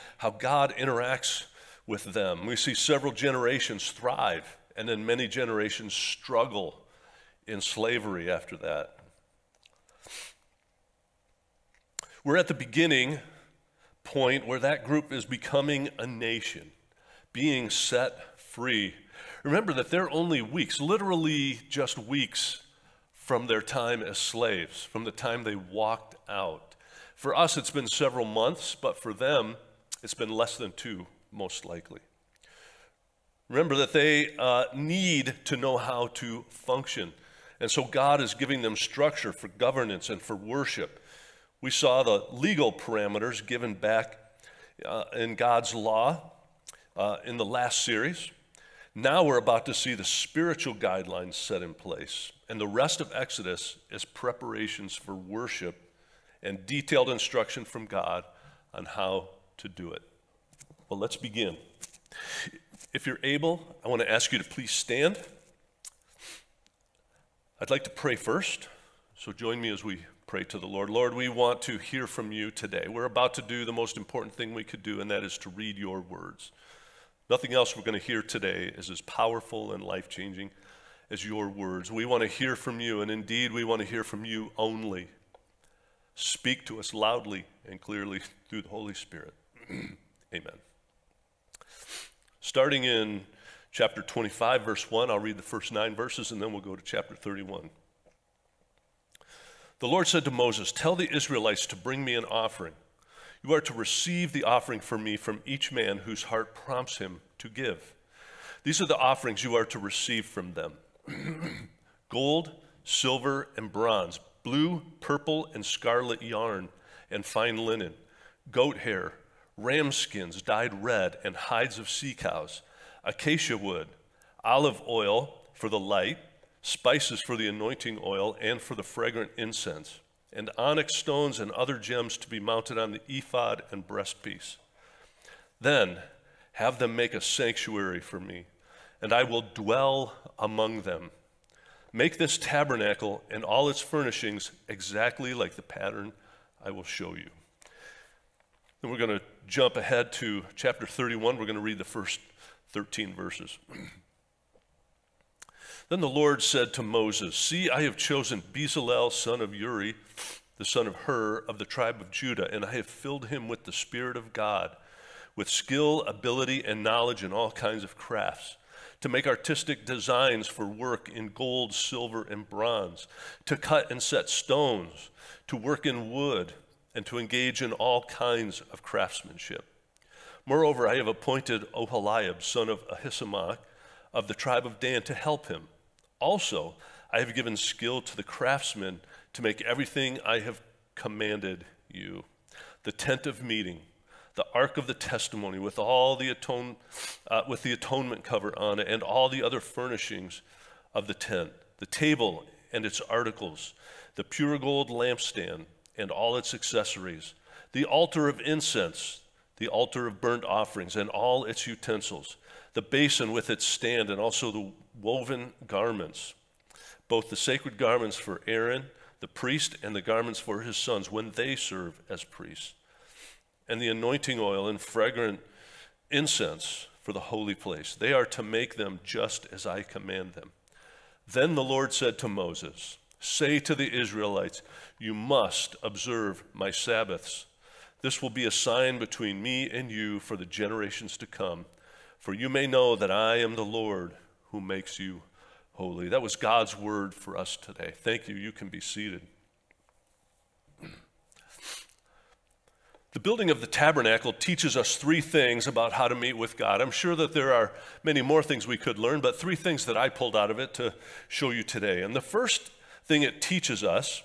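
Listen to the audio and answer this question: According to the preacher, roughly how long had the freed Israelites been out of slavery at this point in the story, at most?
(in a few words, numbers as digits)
less than 2 months.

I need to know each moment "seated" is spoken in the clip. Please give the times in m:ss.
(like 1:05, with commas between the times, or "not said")
4:08.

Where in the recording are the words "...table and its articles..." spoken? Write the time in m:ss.
3:21.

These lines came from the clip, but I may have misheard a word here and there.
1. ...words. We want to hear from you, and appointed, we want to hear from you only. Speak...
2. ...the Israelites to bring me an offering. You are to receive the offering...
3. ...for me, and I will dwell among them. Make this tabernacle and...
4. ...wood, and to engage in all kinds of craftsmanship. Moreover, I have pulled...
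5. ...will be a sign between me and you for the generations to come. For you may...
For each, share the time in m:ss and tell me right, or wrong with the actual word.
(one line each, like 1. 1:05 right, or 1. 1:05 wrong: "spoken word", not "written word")
1. 1:21 wrong: "indeed", not "appointed"
2. 1:40 right
3. 2:17 right
4. 2:56 wrong: "appointed", not "pulled"
5. 3:58 right.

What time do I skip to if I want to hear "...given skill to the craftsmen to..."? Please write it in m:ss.
3:07.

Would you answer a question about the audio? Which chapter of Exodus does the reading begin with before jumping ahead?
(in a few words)
25.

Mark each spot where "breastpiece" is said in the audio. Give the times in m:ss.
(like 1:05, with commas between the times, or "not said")
2:13.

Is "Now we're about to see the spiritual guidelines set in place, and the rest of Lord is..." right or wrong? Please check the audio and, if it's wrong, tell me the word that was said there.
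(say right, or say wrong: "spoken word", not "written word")
wrong: "Exodus", not "Lord".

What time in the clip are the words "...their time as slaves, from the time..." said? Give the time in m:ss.
0:23.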